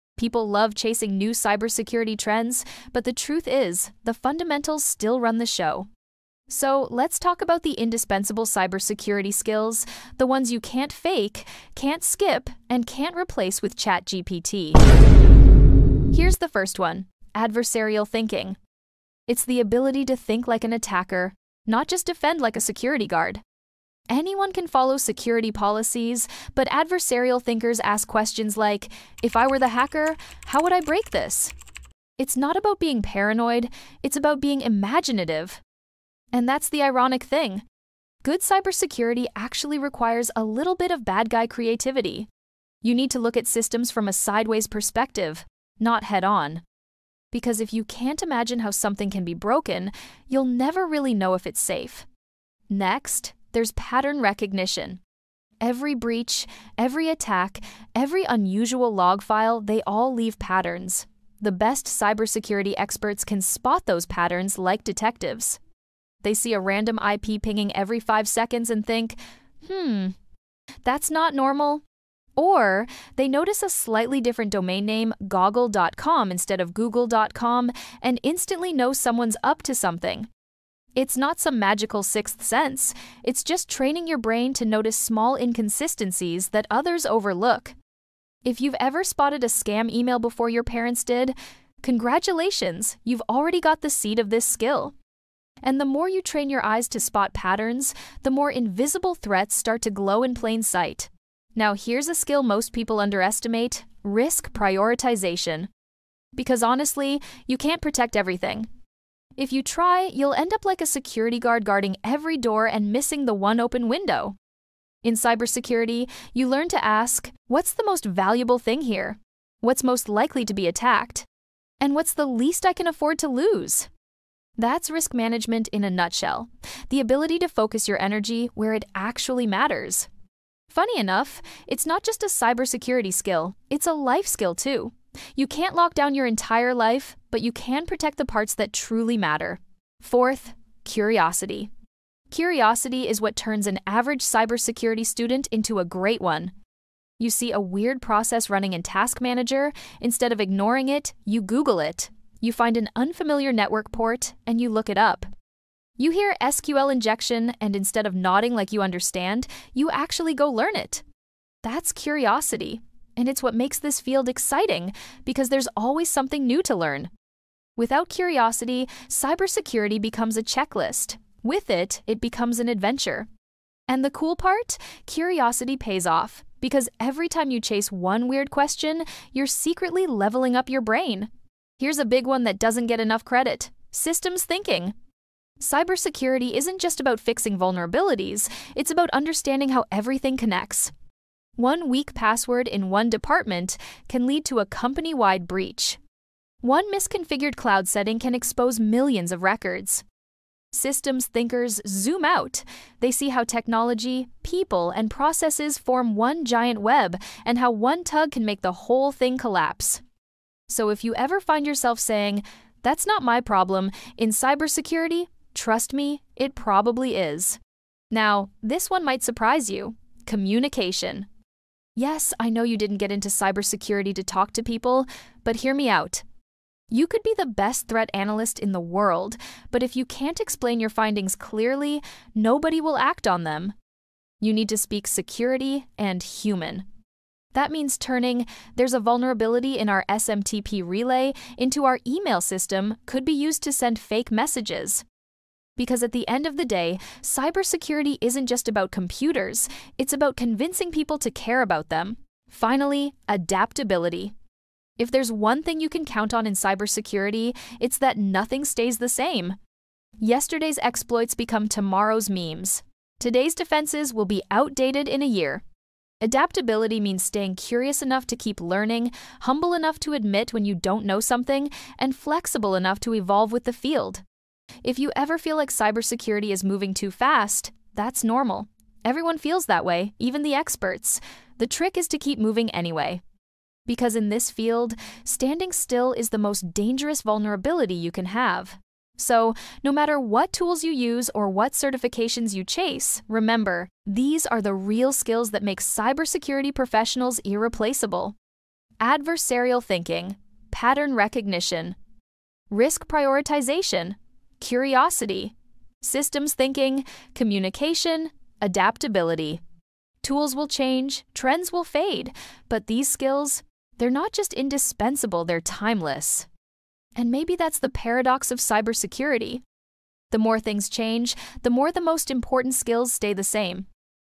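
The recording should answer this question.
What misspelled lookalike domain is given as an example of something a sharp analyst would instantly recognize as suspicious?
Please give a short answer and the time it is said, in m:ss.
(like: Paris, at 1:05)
goggle.com, at 1:15.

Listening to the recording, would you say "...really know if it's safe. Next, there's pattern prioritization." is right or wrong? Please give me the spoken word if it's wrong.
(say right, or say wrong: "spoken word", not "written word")
wrong: "recognition", not "prioritization".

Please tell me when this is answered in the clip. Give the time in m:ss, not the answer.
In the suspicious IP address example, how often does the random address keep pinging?
1:07.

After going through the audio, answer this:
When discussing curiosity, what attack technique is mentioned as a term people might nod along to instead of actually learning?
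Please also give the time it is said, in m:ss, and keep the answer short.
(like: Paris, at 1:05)
SQL injection, at 2:36.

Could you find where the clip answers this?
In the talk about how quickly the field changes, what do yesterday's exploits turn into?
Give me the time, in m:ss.
4:21.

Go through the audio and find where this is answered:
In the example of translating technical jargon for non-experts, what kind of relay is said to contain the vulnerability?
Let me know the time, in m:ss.
4:00.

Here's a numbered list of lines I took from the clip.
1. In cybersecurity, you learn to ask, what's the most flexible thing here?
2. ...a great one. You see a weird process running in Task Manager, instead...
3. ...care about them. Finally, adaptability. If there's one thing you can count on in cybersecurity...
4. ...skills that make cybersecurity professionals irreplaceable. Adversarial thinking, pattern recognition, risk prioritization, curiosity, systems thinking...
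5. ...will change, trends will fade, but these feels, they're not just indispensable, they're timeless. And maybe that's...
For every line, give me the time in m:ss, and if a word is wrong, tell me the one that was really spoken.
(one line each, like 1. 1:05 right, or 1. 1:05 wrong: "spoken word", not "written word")
1. 1:55 wrong: "valuable", not "flexible"
2. 2:25 right
3. 4:11 right
4. 4:55 right
5. 5:10 wrong: "skills", not "feels".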